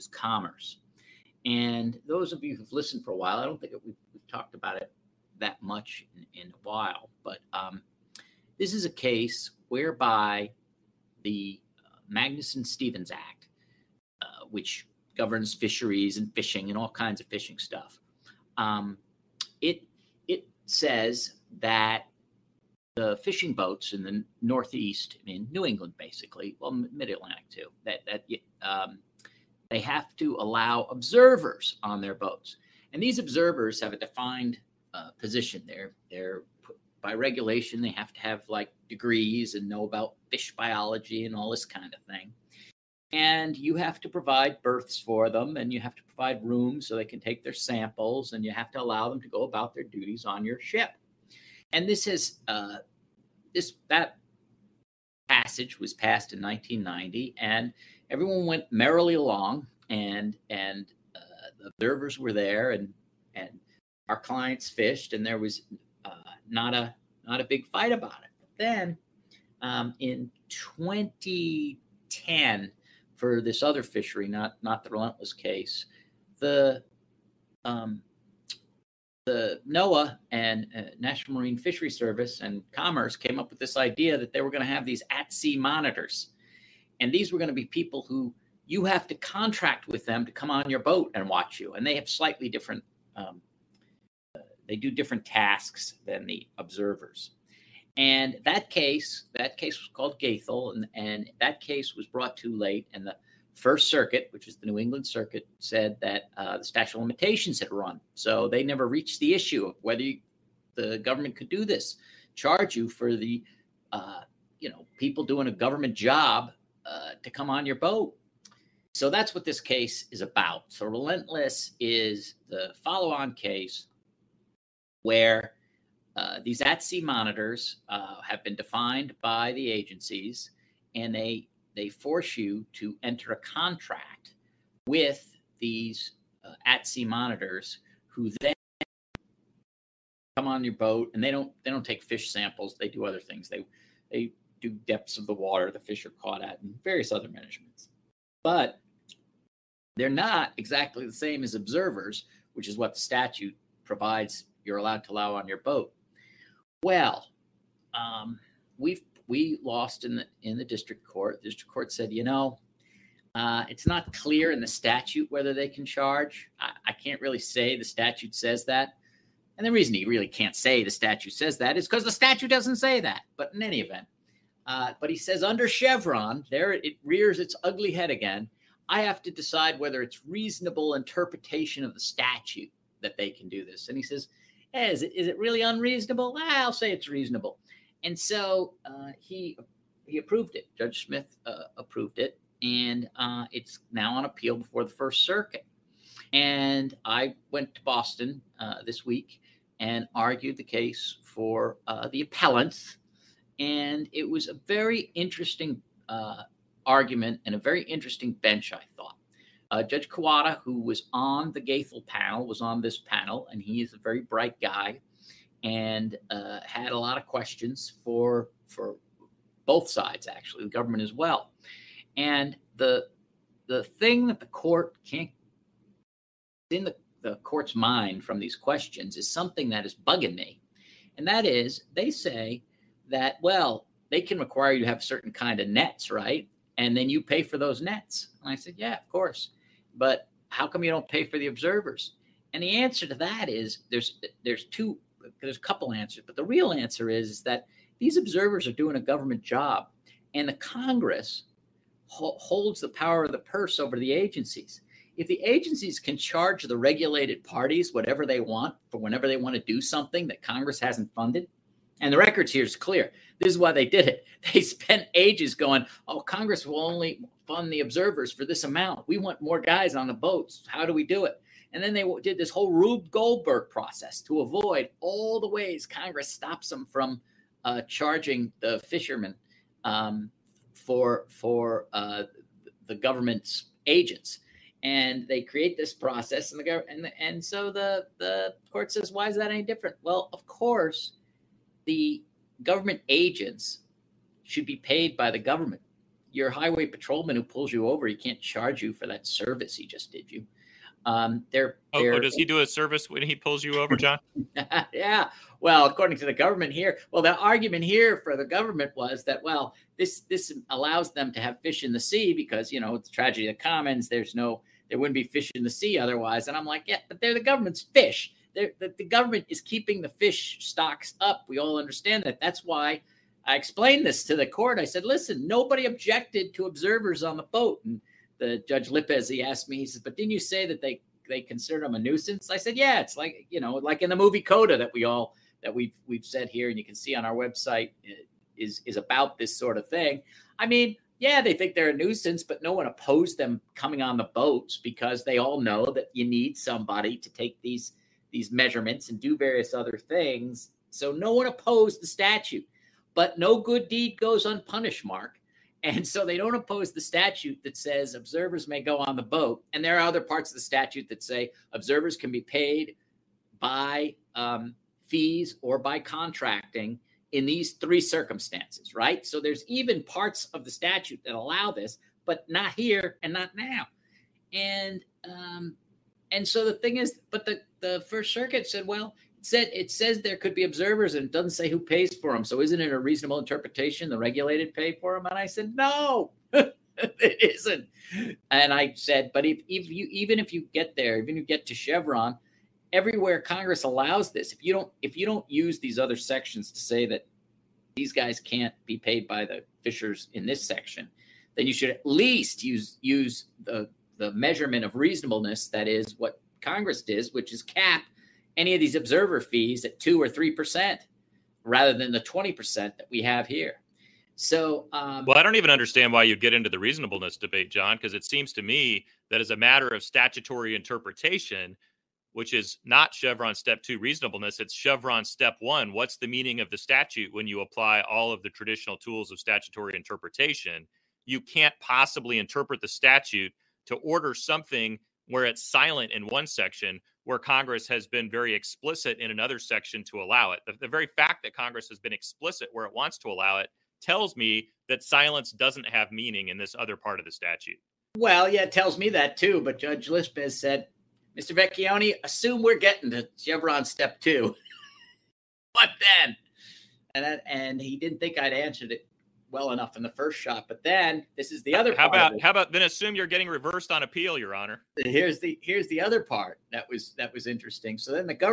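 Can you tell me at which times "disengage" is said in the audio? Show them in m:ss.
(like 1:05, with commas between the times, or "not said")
not said.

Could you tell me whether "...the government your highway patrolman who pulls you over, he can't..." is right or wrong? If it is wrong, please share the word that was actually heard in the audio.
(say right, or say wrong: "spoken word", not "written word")
right.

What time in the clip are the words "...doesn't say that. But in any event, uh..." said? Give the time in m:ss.
2:52.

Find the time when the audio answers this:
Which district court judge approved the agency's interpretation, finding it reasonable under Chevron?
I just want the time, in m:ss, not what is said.
3:10.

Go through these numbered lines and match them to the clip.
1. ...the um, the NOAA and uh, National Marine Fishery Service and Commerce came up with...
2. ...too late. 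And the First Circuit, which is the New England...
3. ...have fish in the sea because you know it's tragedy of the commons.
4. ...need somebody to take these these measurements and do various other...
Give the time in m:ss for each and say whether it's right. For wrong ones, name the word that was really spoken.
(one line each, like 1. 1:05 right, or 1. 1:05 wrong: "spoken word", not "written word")
1. 1:16 right
2. 1:42 right
3. 5:11 right
4. 5:46 right.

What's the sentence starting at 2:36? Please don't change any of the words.
Well, um, we've we lost in the in the district court.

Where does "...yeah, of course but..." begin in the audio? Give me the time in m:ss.
3:58.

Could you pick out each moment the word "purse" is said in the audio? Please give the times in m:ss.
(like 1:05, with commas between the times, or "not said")
4:13.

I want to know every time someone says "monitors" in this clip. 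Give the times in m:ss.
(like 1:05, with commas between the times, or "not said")
1:25, 2:07, 2:17.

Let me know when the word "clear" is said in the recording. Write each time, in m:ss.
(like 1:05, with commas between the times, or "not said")
2:44, 4:22.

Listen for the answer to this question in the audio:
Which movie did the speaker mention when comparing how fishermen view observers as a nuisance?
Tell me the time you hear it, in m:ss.
5:34.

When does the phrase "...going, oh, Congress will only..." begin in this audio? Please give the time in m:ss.
4:25.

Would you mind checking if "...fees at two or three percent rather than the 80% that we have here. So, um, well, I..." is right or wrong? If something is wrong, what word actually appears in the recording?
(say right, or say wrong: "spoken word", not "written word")
wrong: "20", not "80".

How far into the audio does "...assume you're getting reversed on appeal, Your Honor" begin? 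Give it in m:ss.
7:42.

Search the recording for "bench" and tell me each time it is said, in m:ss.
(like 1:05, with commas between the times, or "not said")
3:28.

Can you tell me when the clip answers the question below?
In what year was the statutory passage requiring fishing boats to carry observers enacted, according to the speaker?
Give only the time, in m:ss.
0:56.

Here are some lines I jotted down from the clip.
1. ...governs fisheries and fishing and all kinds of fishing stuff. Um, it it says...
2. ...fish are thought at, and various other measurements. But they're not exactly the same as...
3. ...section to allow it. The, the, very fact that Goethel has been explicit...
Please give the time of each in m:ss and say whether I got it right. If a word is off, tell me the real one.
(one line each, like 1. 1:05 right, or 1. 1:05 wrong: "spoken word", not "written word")
1. 0:15 right
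2. 2:25 wrong: "caught", not "thought"
3. 7:19 wrong: "Congress", not "Goethel".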